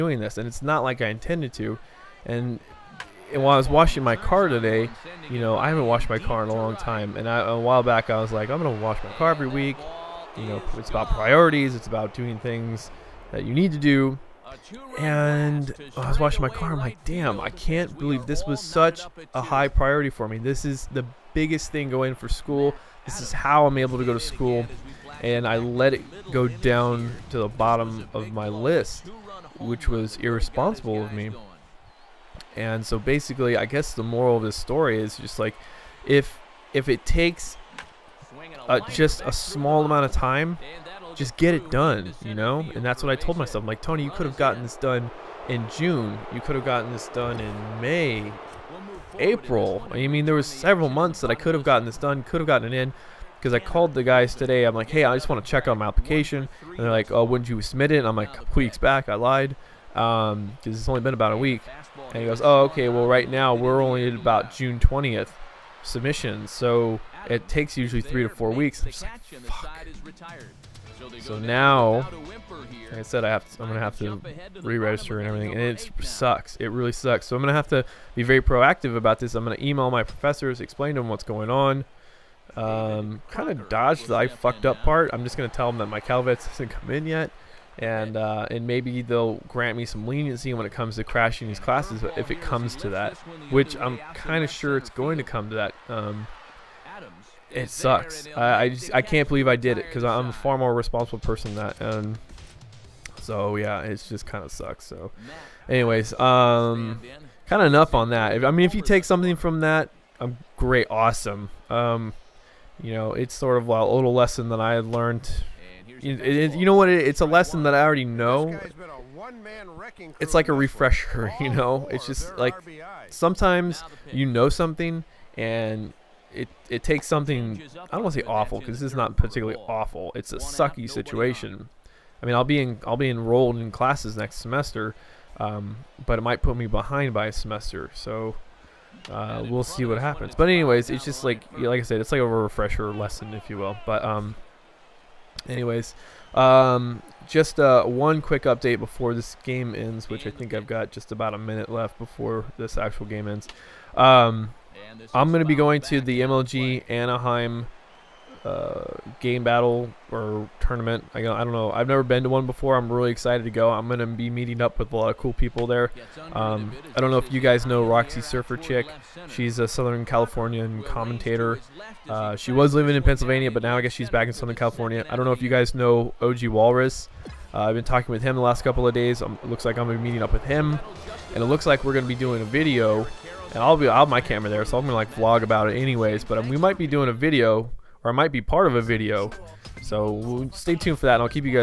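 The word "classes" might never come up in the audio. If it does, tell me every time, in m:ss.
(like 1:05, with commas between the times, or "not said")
1:31, 2:13.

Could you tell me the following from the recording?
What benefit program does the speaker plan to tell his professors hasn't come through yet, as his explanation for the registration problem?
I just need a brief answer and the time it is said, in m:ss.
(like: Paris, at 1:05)
Calvets, at 1:26.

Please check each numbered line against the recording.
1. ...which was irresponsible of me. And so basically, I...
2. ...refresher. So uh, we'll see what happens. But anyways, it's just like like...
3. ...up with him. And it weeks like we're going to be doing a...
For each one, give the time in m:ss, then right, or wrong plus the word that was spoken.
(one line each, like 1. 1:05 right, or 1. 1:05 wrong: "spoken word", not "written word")
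1. 0:29 right
2. 2:17 wrong: "semester", not "refresher"
3. 3:00 wrong: "looks", not "weeks".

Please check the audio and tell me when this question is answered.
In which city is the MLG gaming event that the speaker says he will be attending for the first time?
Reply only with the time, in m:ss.
2:36.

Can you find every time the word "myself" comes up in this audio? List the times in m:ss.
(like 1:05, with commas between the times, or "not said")
0:43.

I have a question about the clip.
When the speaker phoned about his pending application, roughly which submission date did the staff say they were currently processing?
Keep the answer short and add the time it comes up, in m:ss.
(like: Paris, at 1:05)
June 20th, at 1:04.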